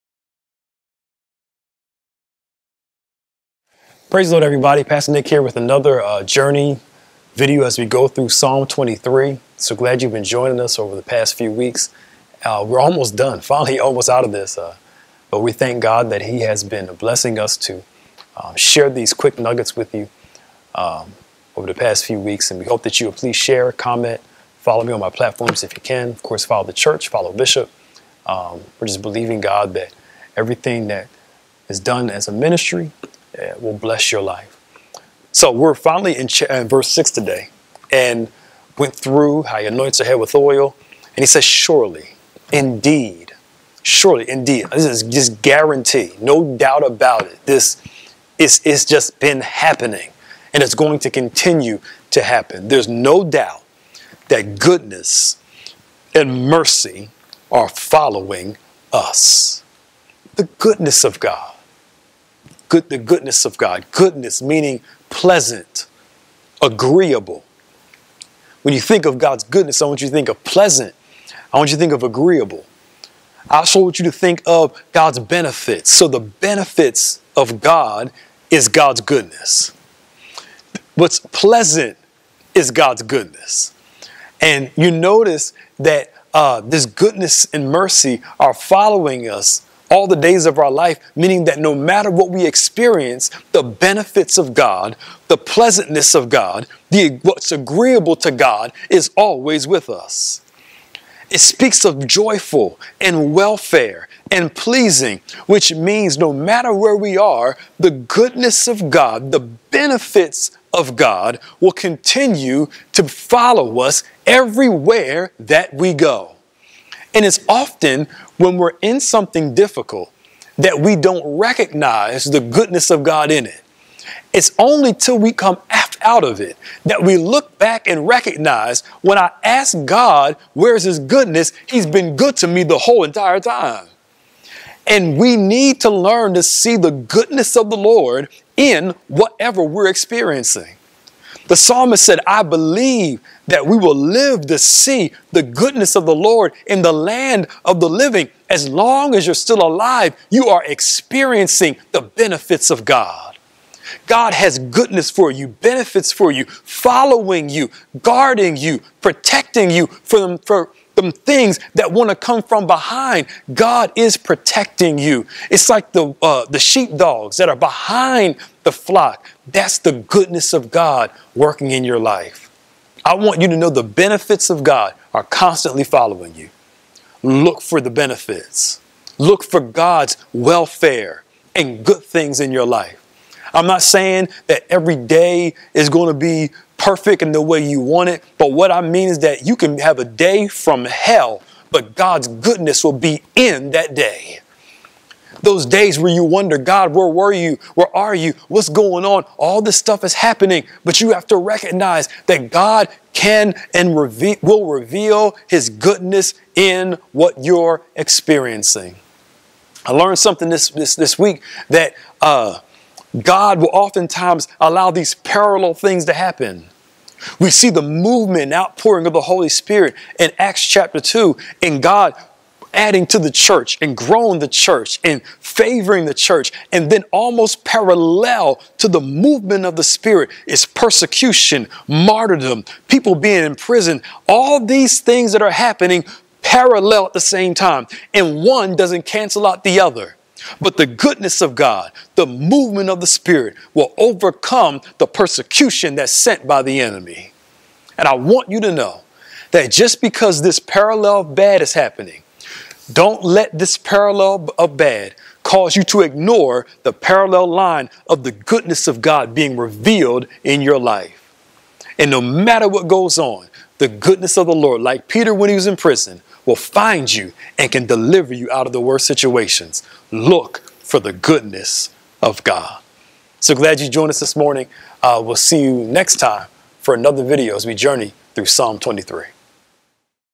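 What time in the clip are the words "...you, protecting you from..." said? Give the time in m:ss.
2:38.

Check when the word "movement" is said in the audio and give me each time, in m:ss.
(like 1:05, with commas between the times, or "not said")
3:37, 3:49, 4:02.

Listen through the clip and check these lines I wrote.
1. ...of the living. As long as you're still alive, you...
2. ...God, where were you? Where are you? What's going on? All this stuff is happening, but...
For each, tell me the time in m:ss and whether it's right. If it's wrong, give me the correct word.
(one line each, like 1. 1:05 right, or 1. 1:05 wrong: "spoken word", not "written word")
1. 2:27 right
2. 3:16 right.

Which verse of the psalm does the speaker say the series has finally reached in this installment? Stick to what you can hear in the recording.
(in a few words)
verse 6.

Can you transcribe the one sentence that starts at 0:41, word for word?
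And he says, Surely, indeed, surely, indeed.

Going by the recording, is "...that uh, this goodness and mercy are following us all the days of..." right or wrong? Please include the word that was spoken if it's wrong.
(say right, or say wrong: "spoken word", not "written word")
right.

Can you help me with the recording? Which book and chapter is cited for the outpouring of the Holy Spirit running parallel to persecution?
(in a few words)
Acts chapter 2.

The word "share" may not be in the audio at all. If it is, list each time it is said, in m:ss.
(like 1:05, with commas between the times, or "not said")
0:18, 0:23.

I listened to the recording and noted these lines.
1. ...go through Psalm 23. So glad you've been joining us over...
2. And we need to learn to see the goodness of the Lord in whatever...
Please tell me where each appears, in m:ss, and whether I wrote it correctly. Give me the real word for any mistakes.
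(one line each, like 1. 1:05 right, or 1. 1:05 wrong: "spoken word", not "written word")
1. 0:07 right
2. 2:14 right.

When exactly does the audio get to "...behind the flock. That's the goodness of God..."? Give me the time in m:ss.
2:47.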